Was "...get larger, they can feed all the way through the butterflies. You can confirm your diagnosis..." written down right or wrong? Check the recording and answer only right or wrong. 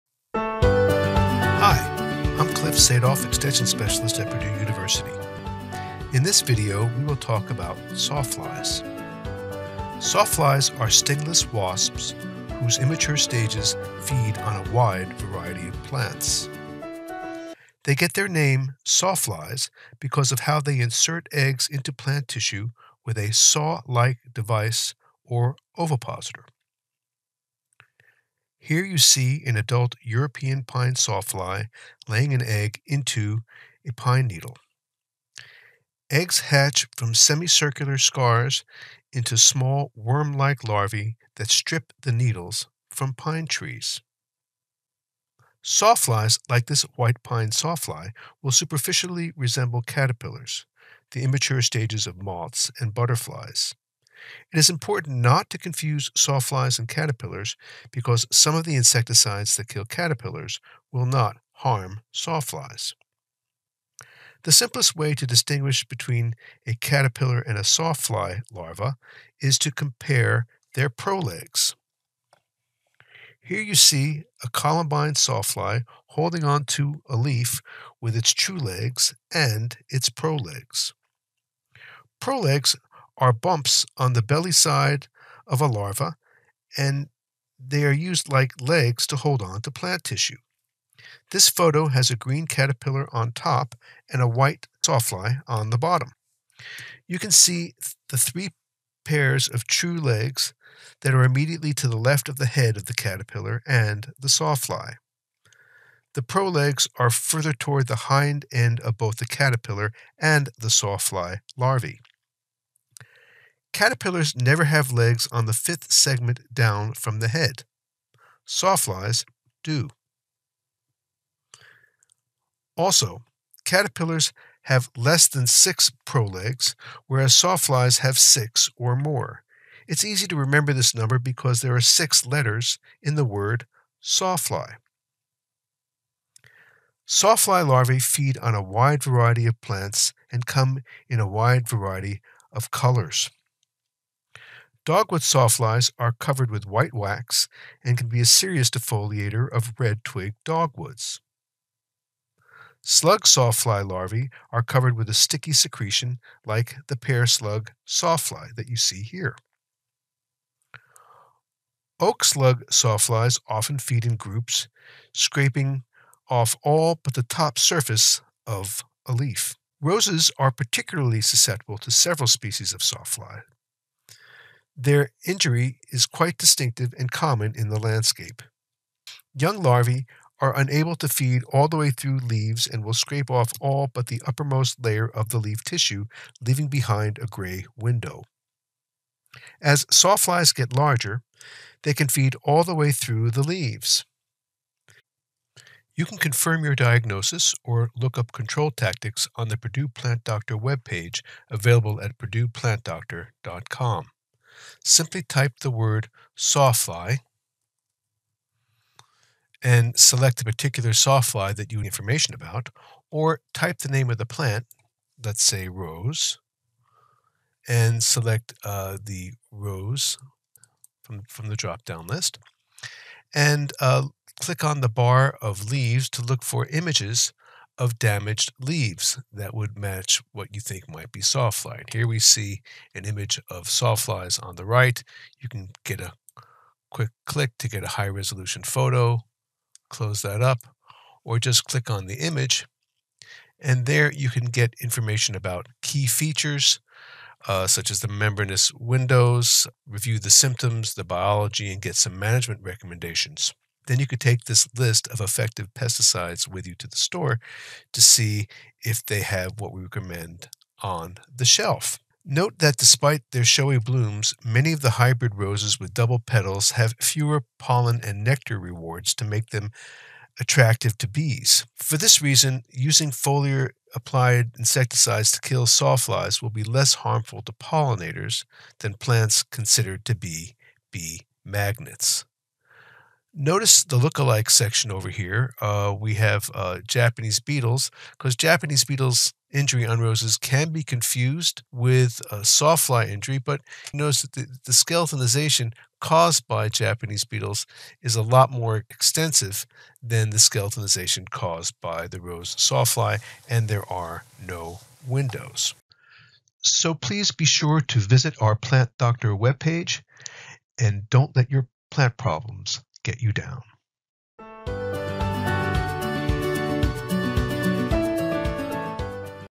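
wrong.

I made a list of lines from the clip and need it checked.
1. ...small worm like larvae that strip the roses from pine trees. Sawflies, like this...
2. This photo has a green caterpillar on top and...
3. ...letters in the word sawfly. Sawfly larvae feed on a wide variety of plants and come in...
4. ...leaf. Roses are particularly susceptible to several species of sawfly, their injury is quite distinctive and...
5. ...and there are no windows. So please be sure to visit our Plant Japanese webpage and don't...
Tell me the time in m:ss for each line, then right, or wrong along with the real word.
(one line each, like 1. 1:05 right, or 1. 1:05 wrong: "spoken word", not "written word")
1. 0:39 wrong: "needles", not "roses"
2. 1:31 right
3. 2:12 right
4. 2:49 right
5. 5:03 wrong: "Doctor", not "Japanese".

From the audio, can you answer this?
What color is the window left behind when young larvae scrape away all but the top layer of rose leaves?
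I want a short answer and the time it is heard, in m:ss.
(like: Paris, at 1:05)
Gray, at 3:07.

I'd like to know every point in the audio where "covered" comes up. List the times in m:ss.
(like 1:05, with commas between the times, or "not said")
2:26, 2:34.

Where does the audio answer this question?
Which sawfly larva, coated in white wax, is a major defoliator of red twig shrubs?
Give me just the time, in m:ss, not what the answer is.
2:24.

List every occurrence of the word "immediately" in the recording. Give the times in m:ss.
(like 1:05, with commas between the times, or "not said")
1:41.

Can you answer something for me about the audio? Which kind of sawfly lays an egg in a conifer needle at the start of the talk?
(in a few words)
European pine sawfly.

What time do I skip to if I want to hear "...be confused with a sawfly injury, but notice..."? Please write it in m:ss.
4:50.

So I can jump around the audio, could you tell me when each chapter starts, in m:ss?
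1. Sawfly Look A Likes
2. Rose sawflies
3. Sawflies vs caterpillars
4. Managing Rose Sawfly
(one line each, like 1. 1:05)
1. 4:43
2. 2:50
3. 0:55
4. 4:13.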